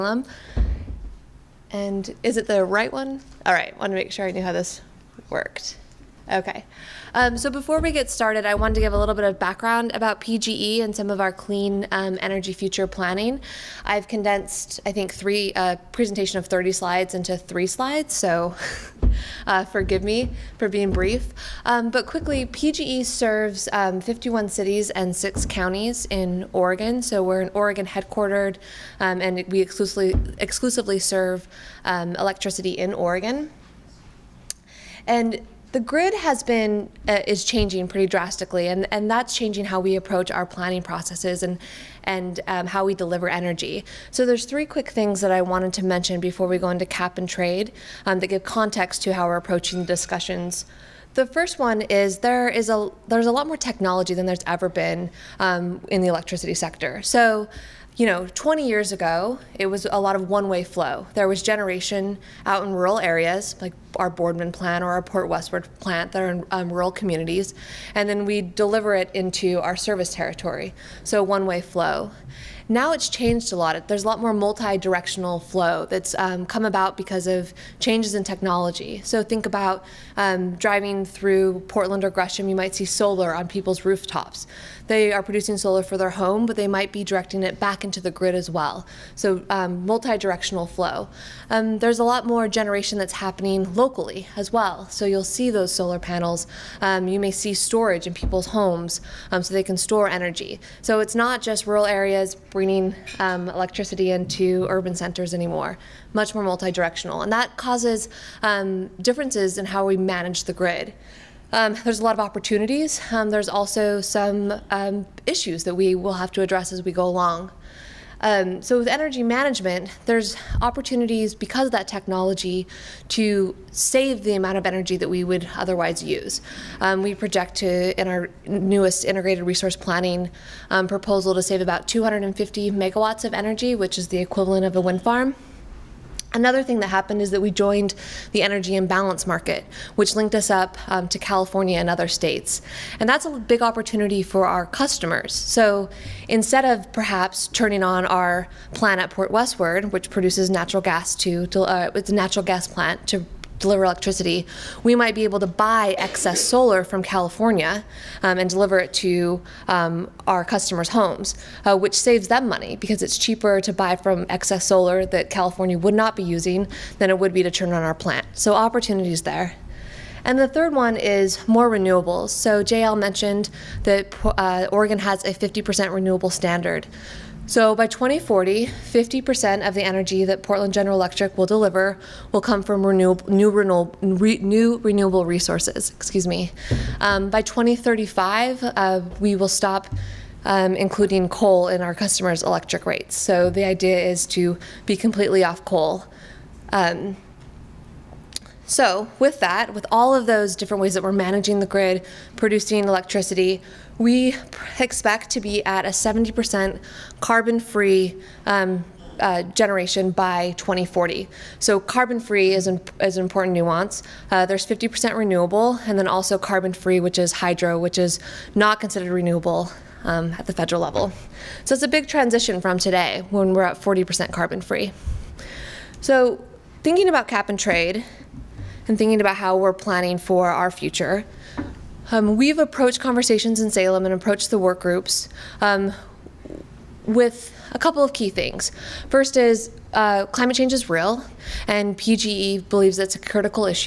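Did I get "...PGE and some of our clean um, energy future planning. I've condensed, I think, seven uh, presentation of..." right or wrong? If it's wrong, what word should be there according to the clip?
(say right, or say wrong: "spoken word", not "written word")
wrong: "three", not "seven".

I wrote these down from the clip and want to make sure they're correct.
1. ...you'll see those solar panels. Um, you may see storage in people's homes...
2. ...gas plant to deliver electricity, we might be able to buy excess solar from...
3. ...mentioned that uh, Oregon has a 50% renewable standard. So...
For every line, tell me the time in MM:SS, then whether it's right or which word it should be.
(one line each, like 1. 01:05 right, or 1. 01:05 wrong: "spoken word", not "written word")
1. 01:35 right
2. 02:32 right
3. 02:52 right.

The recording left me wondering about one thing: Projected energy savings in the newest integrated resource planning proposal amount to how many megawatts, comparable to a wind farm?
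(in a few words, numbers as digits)
250 megawatts.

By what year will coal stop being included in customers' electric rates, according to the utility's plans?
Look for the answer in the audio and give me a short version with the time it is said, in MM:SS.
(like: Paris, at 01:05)
2035, at 03:07.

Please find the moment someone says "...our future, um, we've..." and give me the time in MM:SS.
03:50.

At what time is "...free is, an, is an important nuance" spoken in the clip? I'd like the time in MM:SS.
03:32.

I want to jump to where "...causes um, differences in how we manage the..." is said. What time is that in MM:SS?
01:47.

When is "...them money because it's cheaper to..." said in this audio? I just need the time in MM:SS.
02:42.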